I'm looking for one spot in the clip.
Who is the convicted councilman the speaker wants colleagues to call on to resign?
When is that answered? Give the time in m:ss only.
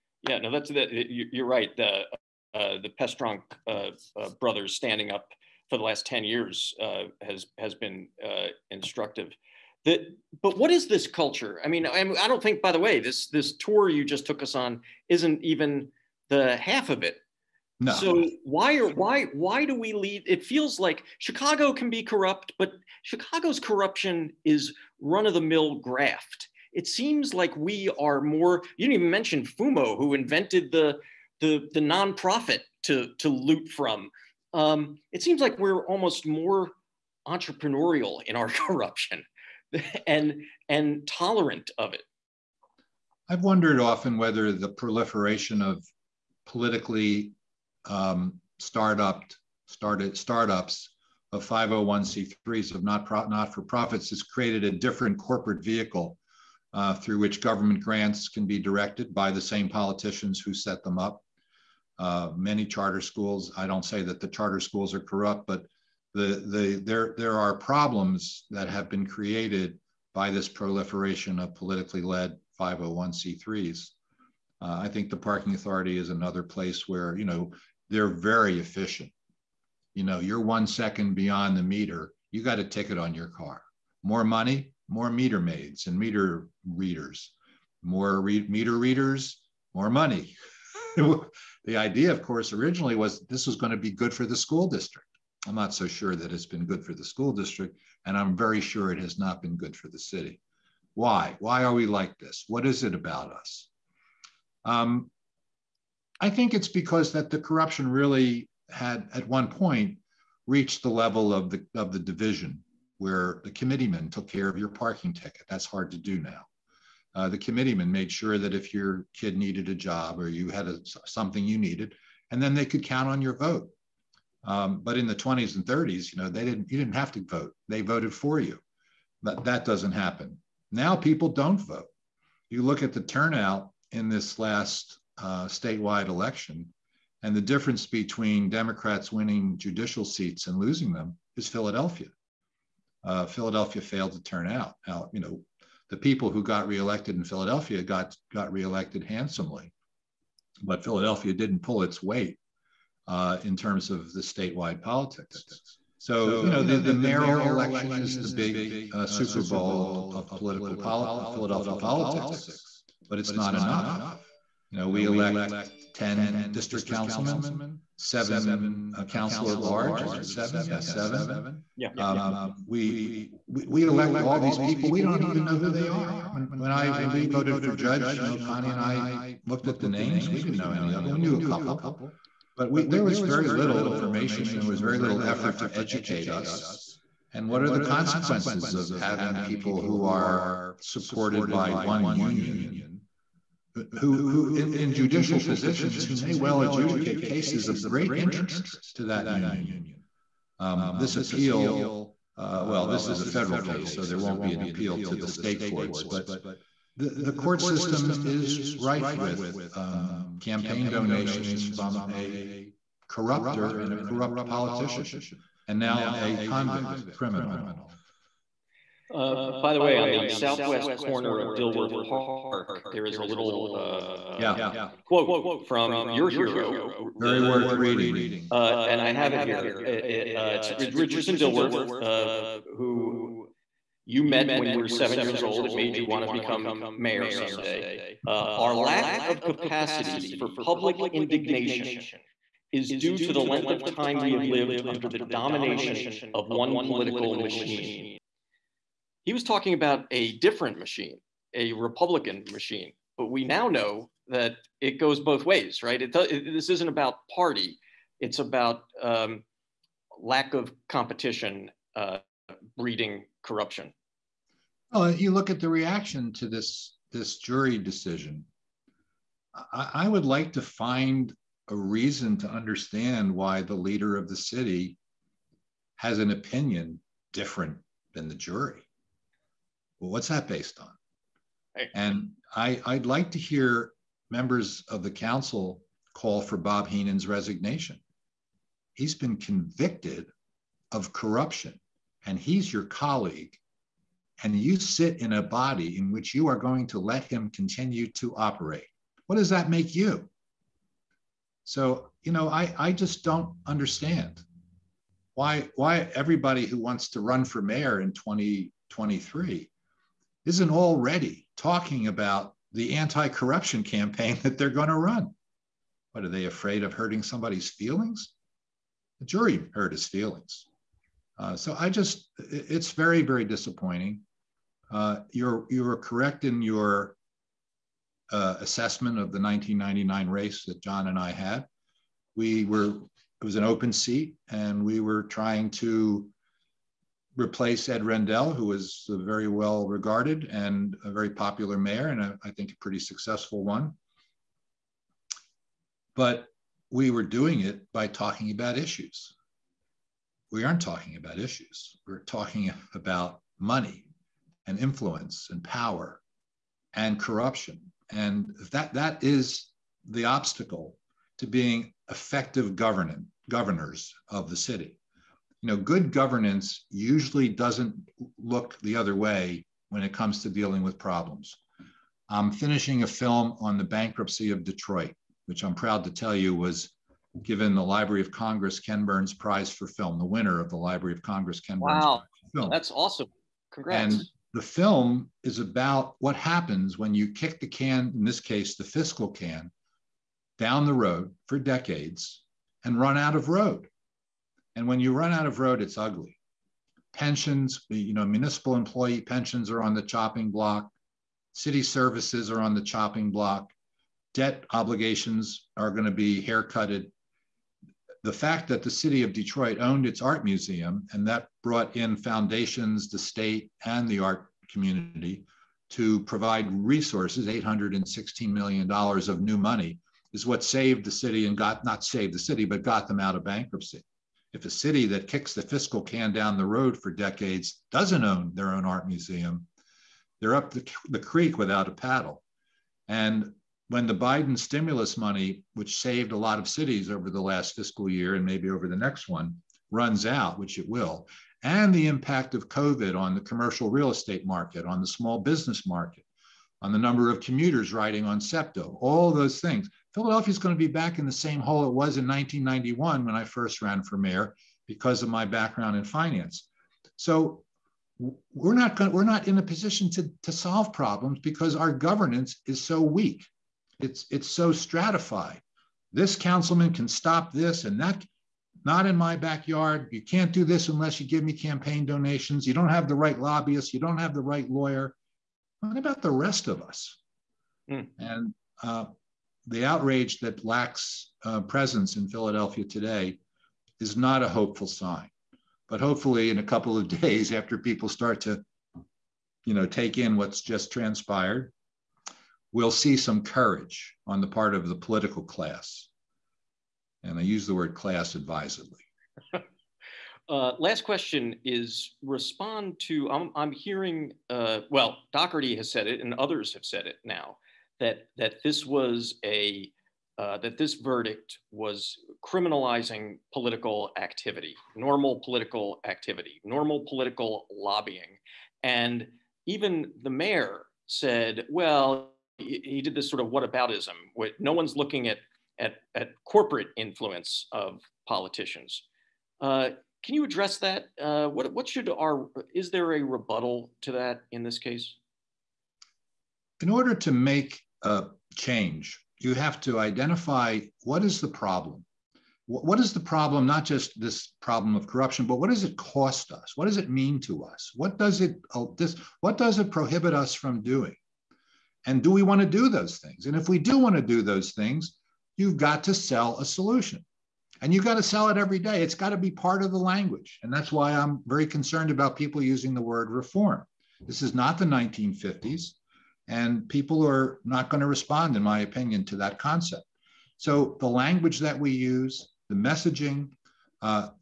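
4:46.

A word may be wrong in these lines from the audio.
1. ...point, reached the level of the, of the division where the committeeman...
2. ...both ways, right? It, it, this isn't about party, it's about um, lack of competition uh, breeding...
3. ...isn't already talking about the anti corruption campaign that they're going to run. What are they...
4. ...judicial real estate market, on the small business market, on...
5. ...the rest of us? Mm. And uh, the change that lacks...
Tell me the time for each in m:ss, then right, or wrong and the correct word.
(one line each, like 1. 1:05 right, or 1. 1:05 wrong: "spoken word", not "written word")
1. 1:49 right
2. 4:15 right
3. 5:10 right
4. 7:23 wrong: "commercial", not "judicial"
5. 7:56 wrong: "outrage", not "change".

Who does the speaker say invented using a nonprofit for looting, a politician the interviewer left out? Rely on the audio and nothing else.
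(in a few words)
Fumo.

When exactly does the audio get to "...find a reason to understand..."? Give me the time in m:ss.
4:30.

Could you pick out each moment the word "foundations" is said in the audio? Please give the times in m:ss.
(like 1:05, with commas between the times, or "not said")
6:52.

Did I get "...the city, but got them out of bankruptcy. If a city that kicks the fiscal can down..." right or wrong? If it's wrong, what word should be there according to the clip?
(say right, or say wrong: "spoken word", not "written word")
right.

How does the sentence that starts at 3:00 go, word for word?
We didn't know any of them.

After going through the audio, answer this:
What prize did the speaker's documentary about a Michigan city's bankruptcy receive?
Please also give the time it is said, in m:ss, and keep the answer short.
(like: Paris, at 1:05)
Library of Congress Ken Burns Prize, at 6:17.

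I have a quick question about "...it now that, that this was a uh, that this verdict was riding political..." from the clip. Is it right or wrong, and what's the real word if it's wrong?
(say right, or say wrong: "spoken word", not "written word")
wrong: "criminalizing", not "riding".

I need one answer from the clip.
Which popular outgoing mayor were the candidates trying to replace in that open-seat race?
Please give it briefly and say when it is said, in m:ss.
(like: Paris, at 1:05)
Ed Rendell, at 5:37.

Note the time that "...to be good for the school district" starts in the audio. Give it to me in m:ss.
1:33.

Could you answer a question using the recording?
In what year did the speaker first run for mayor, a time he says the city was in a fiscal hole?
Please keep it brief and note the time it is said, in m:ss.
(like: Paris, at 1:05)
1991, at 7:32.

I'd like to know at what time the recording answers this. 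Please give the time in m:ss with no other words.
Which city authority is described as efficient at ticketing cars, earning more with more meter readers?
1:15.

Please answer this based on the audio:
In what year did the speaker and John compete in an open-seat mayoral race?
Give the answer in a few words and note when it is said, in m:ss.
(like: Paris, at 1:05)
1999, at 5:29.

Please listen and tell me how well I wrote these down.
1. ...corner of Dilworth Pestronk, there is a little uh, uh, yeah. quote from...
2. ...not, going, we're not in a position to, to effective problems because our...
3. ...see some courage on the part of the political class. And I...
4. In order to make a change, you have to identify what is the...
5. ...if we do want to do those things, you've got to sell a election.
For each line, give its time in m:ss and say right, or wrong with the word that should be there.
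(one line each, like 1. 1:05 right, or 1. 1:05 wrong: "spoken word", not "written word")
1. 3:40 wrong: "Park", not "Pestronk"
2. 7:38 wrong: "solve", not "effective"
3. 8:12 right
4. 8:56 right
5. 9:13 wrong: "solution", not "election".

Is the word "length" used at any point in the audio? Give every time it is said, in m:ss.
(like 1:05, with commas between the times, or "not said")
4:03.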